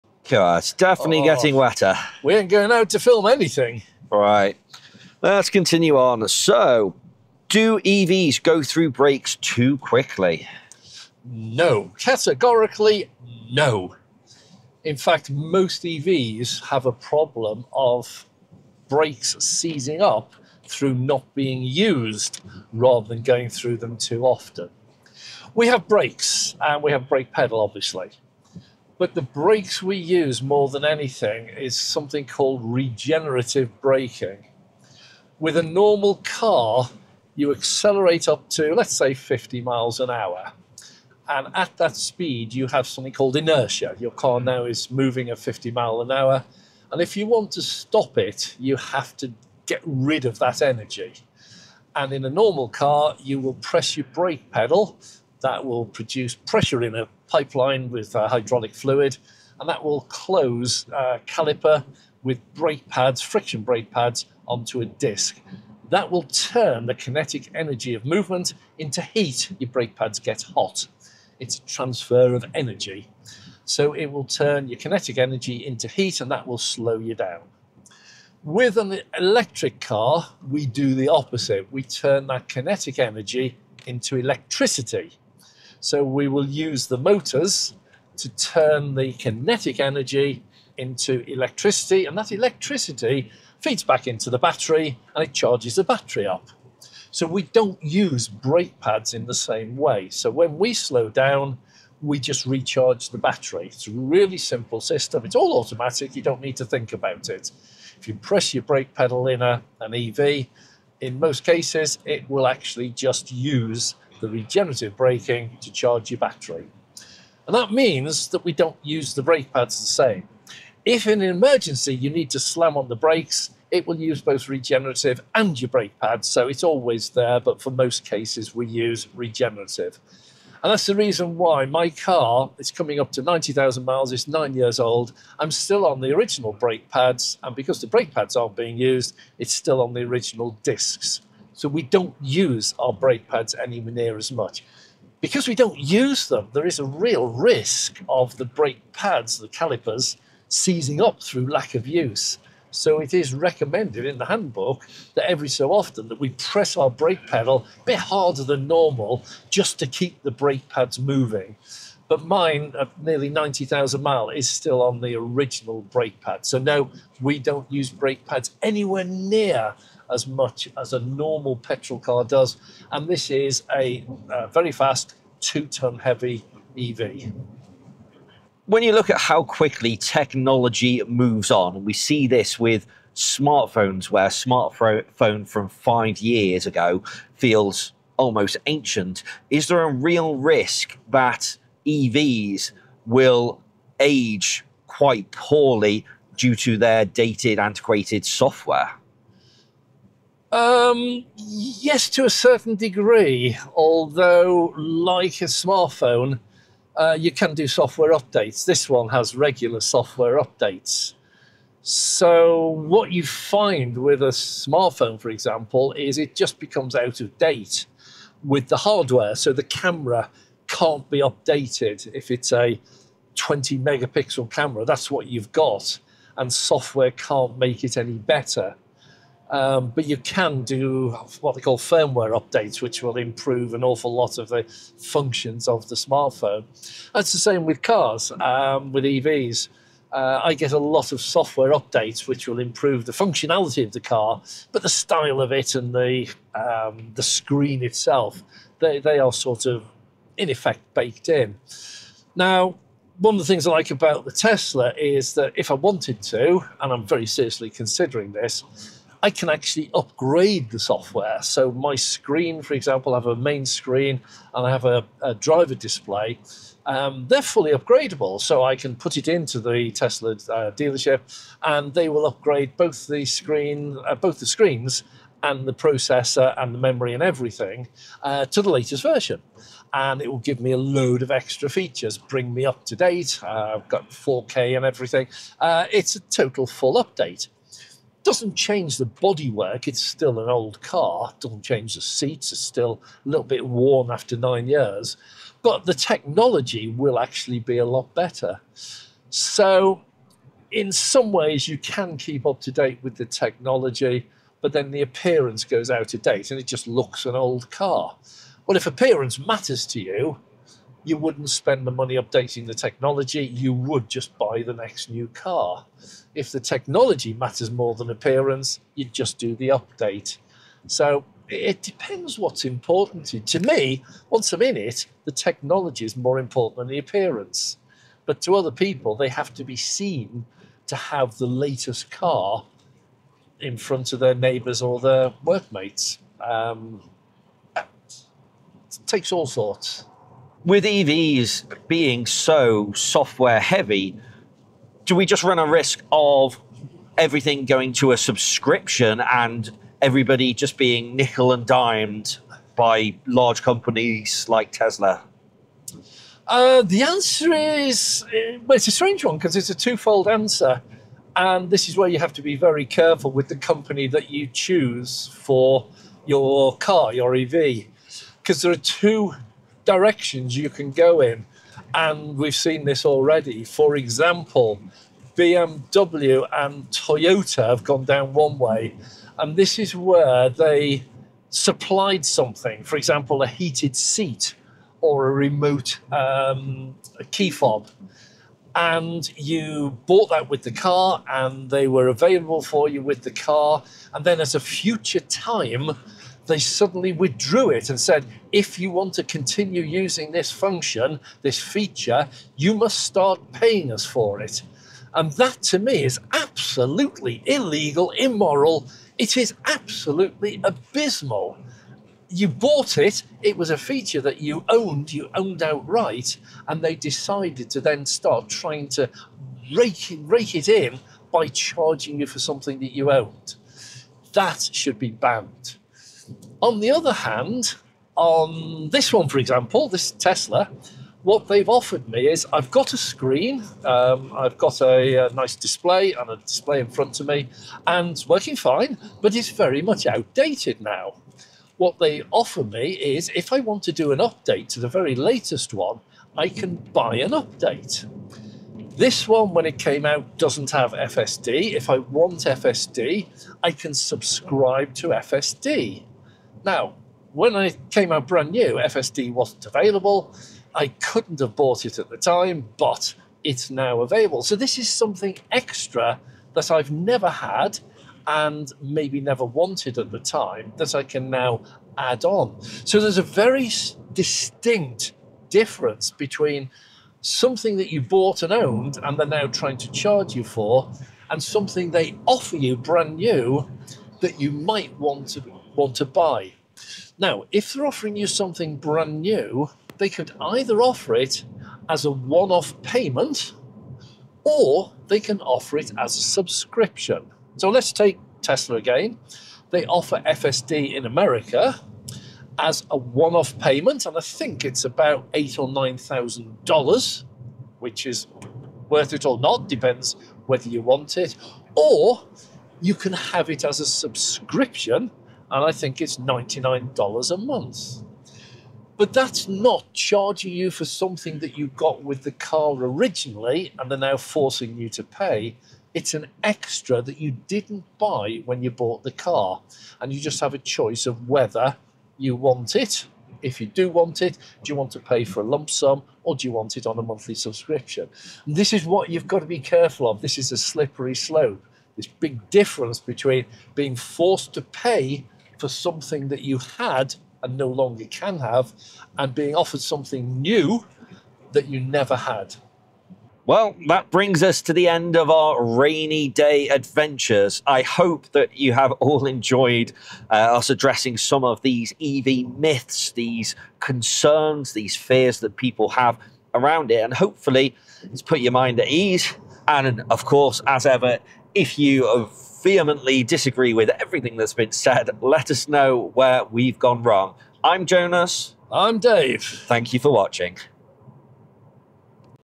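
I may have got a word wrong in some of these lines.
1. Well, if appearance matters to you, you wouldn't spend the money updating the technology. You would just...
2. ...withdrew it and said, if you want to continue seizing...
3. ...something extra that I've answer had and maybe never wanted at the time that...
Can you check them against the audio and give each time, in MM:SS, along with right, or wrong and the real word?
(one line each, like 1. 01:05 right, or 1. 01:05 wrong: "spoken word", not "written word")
1. 05:08 right
2. 06:37 wrong: "using", not "seizing"
3. 07:44 wrong: "never", not "answer".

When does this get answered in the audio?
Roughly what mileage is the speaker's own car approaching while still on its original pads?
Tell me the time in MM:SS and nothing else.
02:13.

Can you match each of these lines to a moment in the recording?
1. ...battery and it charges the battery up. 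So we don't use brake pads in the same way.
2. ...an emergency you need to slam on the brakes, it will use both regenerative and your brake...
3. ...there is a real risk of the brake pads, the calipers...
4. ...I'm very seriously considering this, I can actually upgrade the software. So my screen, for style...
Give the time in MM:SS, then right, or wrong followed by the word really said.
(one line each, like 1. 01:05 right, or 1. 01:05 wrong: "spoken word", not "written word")
1. 01:34 right
2. 02:01 right
3. 02:26 right
4. 04:16 wrong: "example", not "style".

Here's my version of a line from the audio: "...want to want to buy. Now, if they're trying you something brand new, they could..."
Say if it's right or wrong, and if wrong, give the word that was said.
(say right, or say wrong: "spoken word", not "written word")
wrong: "offering", not "trying".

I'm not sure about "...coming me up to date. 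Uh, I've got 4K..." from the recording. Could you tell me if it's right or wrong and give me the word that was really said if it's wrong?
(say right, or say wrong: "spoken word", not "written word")
wrong: "bring", not "coming".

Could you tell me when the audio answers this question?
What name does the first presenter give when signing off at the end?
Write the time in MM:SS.
09:37.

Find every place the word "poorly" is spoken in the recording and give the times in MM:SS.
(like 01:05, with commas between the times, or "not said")
03:15.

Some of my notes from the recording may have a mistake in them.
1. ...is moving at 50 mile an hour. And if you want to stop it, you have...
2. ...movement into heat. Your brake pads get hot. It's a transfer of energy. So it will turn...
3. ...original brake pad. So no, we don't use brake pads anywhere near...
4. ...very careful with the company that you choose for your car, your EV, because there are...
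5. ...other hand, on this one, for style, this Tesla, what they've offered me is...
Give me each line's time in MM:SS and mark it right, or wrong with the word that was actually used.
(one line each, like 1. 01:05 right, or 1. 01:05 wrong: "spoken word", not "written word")
1. 00:44 right
2. 01:08 right
3. 02:45 right
4. 06:02 right
5. 07:06 wrong: "example", not "style".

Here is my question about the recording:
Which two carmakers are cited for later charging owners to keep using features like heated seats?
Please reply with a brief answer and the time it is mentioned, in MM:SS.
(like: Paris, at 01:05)
BMW and Toyota, at 06:15.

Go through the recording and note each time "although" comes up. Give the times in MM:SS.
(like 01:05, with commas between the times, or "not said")
03:23.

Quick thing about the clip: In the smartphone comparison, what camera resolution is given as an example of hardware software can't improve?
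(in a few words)
20 megapixel.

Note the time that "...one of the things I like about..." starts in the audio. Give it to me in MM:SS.
04:13.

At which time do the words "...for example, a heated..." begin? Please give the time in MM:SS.
06:22.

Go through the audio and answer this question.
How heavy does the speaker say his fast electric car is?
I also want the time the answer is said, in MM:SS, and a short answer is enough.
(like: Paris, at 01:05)
two ton, at 02:55.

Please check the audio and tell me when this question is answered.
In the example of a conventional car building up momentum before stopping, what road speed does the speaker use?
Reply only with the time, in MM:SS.
00:39.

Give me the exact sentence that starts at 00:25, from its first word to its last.
We have brakes and we have brake pedal, obviously.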